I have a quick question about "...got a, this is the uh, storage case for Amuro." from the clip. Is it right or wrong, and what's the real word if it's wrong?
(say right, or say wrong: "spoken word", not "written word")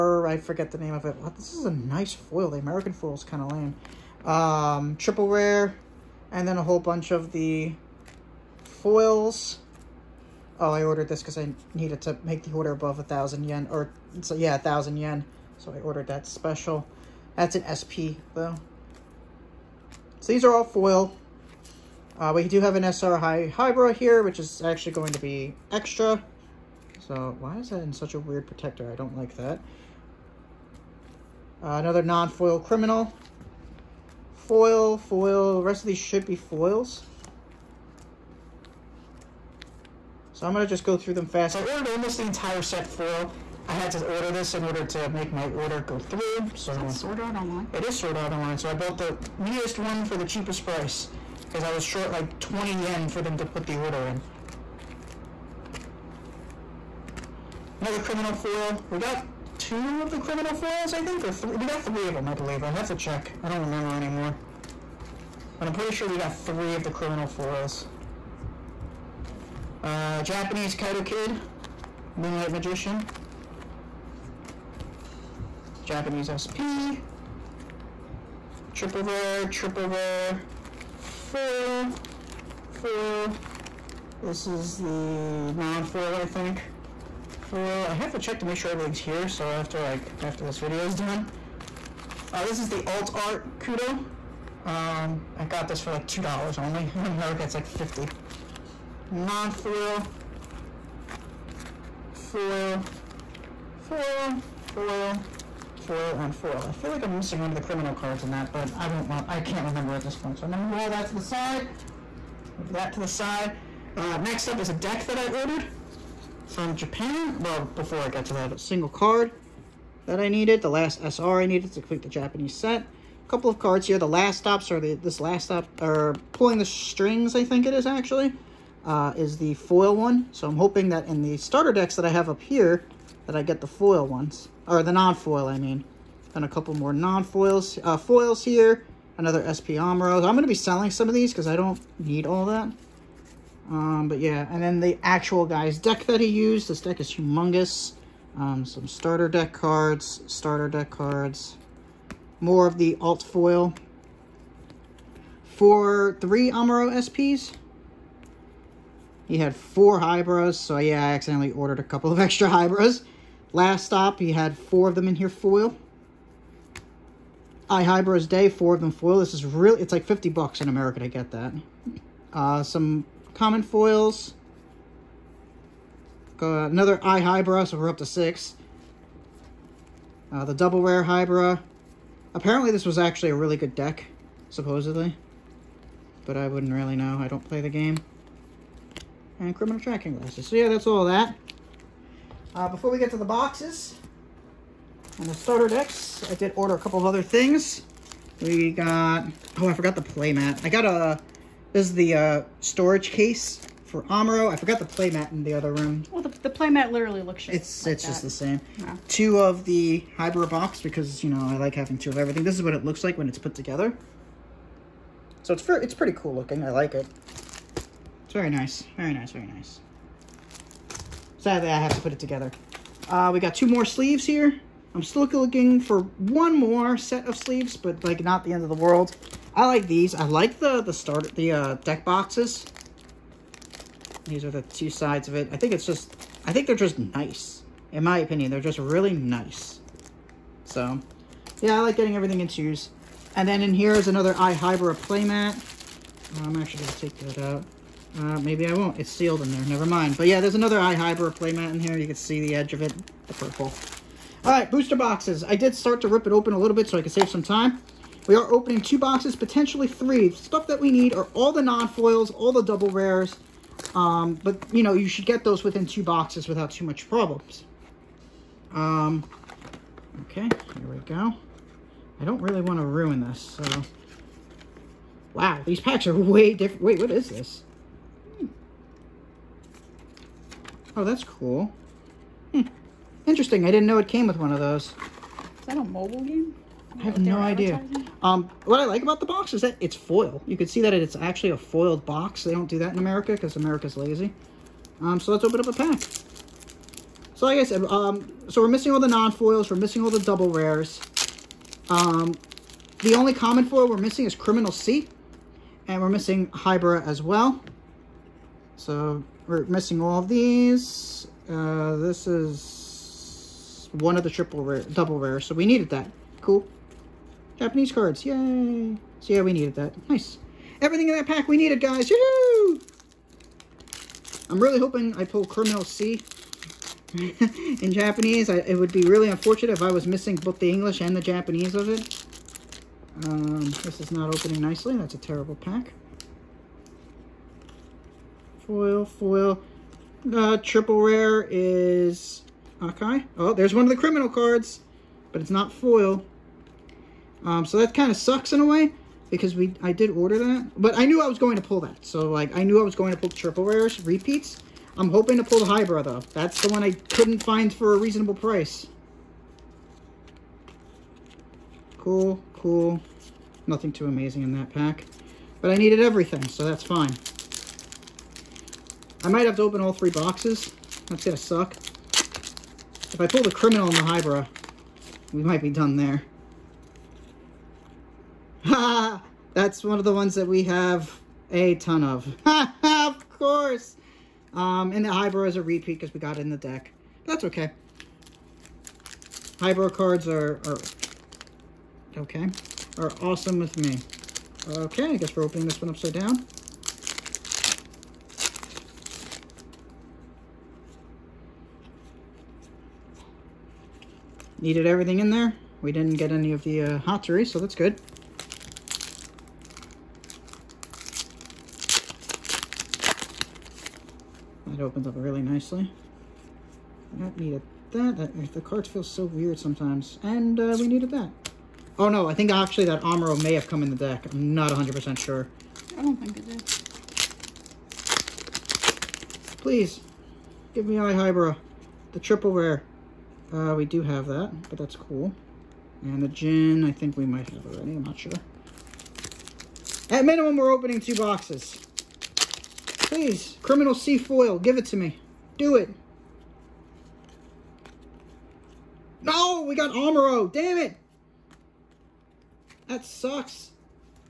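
right.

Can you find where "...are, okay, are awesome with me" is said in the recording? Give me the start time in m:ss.
6:30.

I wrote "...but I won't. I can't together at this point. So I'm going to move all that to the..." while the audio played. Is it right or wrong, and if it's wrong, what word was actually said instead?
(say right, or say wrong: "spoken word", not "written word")
wrong: "remember", not "together".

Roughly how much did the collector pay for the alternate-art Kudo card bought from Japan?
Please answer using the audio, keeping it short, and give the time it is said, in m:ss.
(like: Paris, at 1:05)
2 dollars, at 1:36.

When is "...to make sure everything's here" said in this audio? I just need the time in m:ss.
1:28.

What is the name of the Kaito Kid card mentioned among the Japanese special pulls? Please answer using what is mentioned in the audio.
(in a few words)
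Moonlight Magician.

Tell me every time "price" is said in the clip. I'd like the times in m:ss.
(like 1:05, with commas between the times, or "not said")
0:50, 5:58.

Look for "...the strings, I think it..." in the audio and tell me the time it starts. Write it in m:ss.
2:06.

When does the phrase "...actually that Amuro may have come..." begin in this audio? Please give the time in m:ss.
7:02.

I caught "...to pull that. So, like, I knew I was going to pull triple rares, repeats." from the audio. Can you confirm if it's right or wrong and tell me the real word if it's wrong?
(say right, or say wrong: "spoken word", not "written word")
right.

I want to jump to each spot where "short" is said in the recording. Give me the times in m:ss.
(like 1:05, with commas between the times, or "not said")
0:51.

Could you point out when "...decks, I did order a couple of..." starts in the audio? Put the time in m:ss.
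3:15.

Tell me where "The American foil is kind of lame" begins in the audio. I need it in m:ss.
0:02.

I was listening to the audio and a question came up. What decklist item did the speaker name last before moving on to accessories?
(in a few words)
criminal tracking glasses.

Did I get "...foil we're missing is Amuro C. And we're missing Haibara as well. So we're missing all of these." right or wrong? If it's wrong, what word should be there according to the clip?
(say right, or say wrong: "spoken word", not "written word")
wrong: "Criminal", not "Amuro".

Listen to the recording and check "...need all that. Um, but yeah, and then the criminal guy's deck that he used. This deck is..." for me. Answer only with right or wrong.
wrong.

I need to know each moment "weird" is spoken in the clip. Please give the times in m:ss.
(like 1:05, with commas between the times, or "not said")
0:28, 6:59.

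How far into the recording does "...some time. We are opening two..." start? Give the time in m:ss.
4:17.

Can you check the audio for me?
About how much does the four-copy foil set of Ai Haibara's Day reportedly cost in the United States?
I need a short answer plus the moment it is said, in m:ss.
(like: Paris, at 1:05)
50 bucks, at 2:50.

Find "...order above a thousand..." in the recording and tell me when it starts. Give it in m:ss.
0:12.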